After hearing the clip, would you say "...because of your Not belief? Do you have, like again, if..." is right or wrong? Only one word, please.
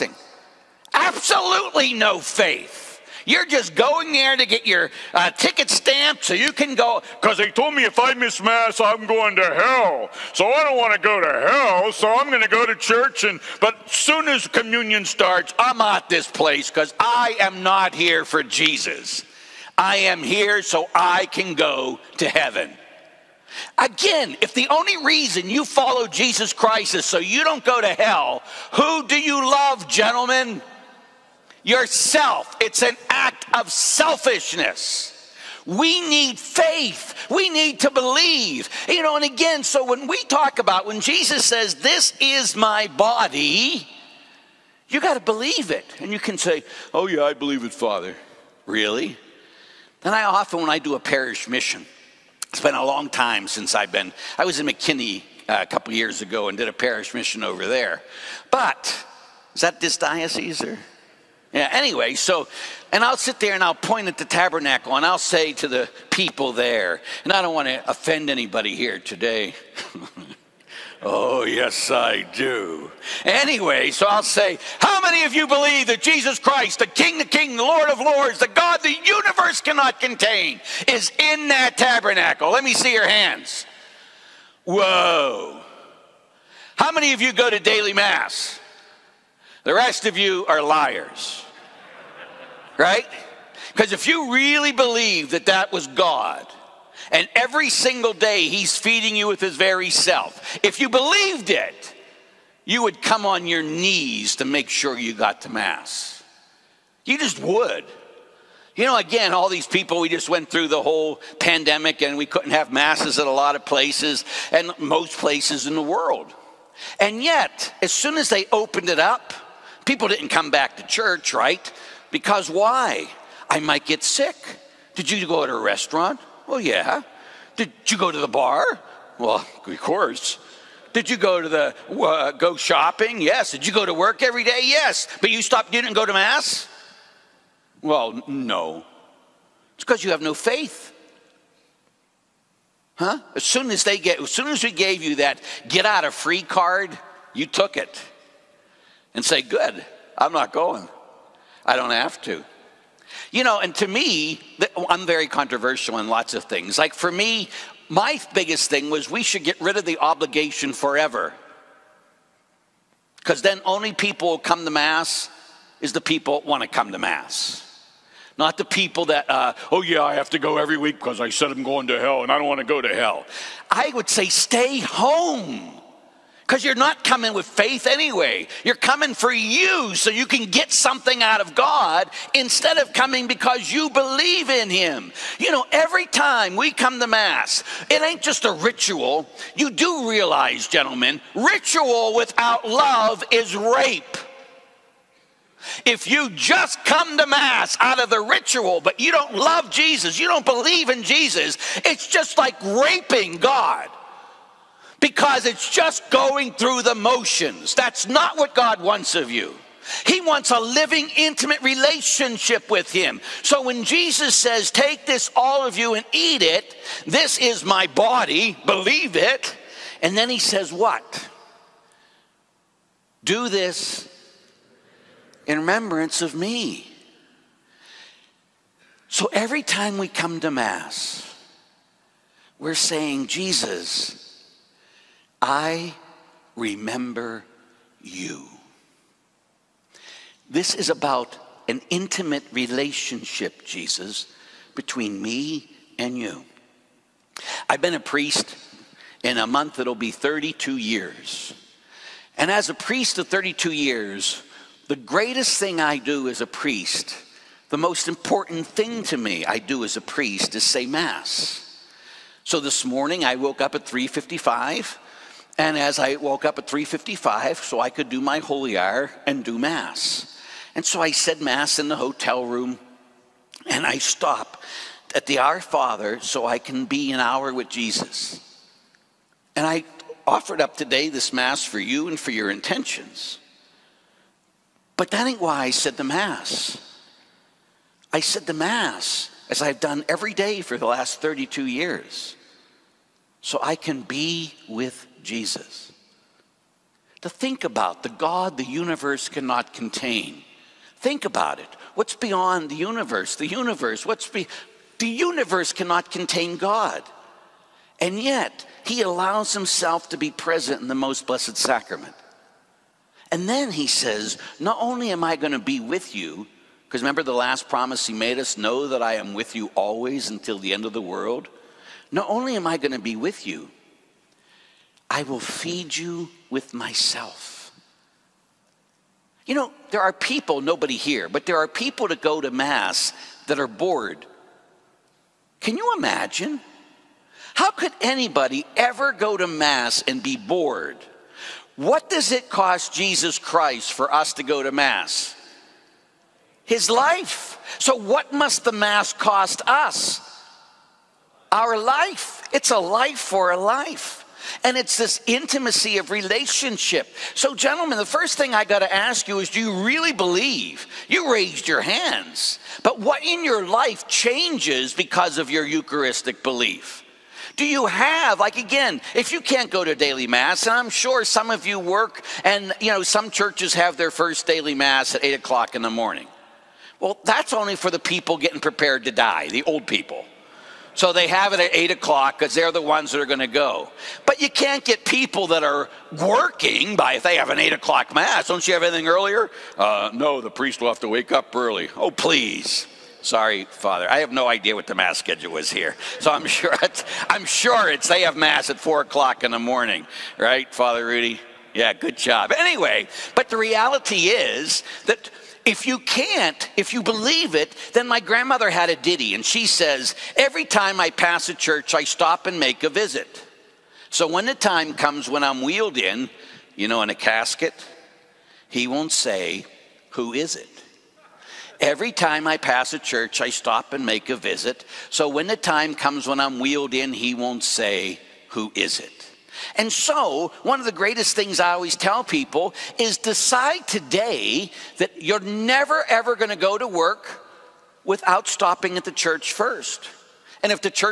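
wrong.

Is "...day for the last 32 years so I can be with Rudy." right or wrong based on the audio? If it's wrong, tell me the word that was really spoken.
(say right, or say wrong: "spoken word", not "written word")
wrong: "Jesus", not "Rudy".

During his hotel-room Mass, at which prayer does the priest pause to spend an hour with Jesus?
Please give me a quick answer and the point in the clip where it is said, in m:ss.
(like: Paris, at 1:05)
the Our Father, at 4:35.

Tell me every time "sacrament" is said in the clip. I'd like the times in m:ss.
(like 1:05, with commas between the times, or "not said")
5:11.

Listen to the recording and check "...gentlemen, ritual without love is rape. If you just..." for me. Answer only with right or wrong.
right.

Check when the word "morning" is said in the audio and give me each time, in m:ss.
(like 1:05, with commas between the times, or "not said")
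4:22, 6:15, 6:39.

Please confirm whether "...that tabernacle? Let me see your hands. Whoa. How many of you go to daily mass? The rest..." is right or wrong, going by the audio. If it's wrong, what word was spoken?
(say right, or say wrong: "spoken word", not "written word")
right.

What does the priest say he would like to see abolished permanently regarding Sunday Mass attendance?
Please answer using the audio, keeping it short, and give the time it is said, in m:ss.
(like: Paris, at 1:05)
the obligation, at 2:39.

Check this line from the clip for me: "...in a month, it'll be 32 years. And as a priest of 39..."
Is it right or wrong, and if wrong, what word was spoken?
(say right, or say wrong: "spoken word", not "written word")
wrong: "32", not "39".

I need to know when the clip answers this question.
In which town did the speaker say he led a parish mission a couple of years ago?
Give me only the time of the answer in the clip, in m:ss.
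0:54.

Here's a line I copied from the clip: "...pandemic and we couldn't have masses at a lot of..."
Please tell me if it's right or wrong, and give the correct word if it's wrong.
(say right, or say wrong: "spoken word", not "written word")
right.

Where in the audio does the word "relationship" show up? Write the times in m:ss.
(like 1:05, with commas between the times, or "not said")
3:31, 4:02, 5:56.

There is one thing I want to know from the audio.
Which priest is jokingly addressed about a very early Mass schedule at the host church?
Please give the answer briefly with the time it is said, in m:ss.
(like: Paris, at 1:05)
Father Rudy, at 6:40.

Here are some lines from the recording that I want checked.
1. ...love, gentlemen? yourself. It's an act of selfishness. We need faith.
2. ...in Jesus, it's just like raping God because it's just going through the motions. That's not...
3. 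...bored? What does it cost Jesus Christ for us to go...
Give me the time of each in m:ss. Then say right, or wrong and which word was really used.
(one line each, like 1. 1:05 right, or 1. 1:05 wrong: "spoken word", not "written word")
1. 0:29 right
2. 3:20 right
3. 5:40 right.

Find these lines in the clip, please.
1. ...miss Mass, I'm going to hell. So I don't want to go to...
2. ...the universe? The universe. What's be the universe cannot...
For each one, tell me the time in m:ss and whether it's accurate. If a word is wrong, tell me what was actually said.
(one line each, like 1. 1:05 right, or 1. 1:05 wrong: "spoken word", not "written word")
1. 0:08 right
2. 5:02 right.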